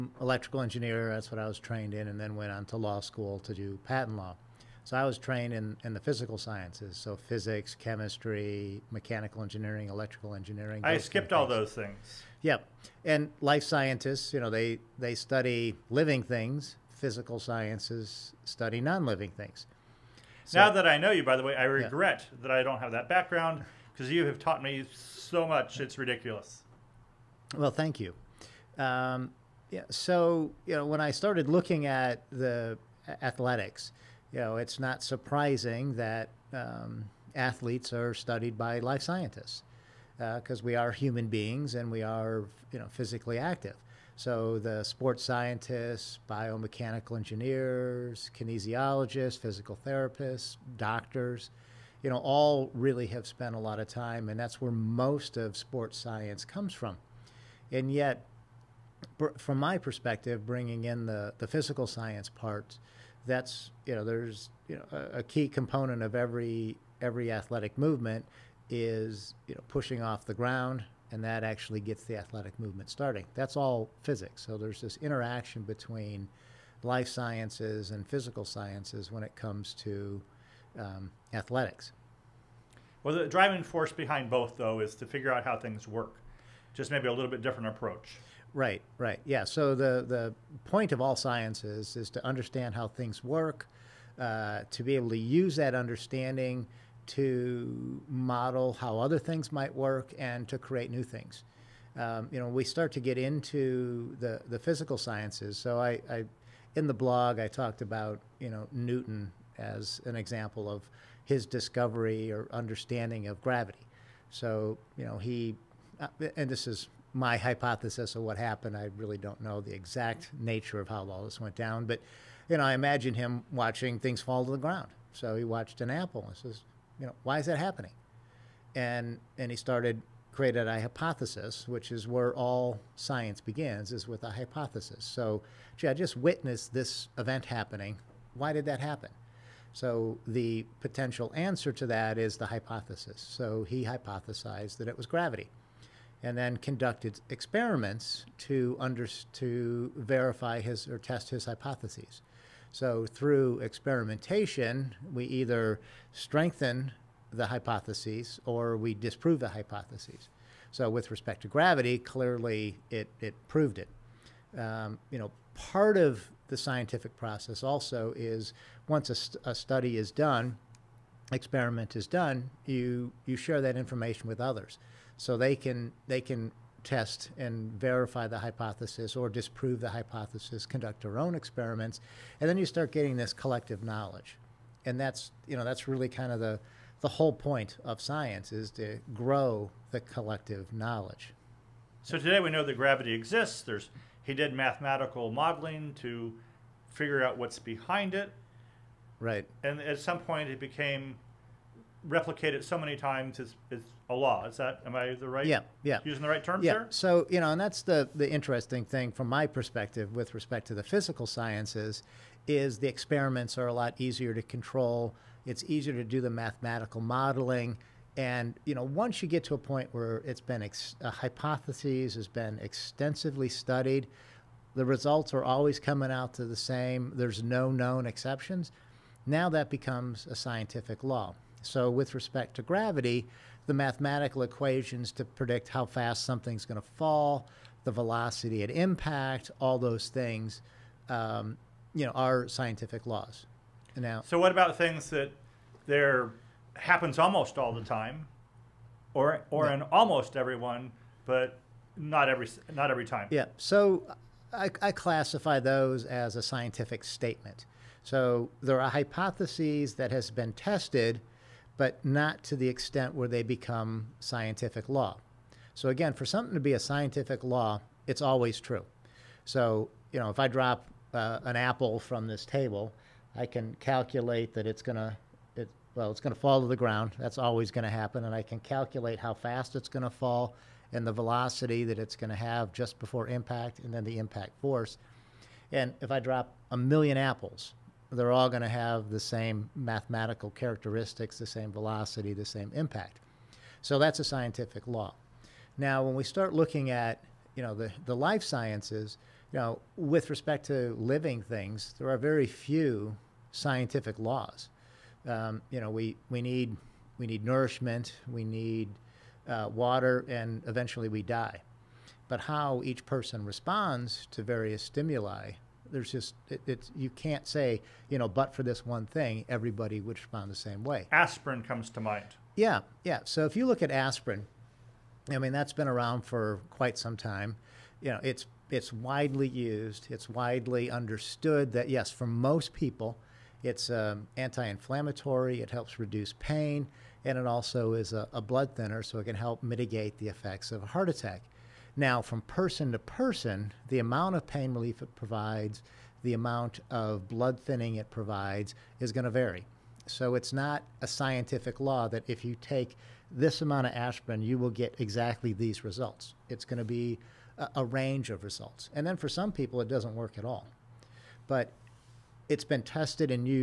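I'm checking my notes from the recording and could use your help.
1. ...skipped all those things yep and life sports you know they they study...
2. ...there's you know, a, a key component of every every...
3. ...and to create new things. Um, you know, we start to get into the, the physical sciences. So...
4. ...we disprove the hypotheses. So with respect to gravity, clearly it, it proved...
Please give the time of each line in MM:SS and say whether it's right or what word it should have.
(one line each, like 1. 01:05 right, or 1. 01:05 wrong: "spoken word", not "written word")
1. 00:10 wrong: "scientists", not "sports"
2. 01:04 right
3. 01:40 right
4. 02:38 right.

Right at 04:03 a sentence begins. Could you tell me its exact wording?
Now, so what about things that there happens almost all the time, or or yeah.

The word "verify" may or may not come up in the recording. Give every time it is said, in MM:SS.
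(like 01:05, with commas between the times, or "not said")
02:29, 02:57.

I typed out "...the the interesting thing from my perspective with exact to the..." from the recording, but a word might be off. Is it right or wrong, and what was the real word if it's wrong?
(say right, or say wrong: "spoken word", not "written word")
wrong: "respect", not "exact".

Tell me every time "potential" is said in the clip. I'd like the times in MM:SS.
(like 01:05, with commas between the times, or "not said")
02:20.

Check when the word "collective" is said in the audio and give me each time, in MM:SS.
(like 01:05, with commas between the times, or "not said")
03:03, 03:10.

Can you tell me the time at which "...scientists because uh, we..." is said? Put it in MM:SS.
00:39.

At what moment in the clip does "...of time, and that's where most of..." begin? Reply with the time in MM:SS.
00:53.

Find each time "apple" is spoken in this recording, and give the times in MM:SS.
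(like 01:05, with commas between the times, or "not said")
02:05, 04:31, 04:47.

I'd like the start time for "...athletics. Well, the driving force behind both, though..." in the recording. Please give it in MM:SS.
01:21.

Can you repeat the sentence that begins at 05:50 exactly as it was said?
So it's not a scientific law that if you take this amount of aspirin, you will get exactly these results.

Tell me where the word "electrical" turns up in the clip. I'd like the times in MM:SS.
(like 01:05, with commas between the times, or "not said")
00:00, 00:09.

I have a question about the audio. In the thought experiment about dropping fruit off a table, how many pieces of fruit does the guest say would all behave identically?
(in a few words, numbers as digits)
a million.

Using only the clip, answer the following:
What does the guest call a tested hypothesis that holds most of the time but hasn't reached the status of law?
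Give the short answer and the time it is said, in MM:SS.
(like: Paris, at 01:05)
scientific statement, at 04:16.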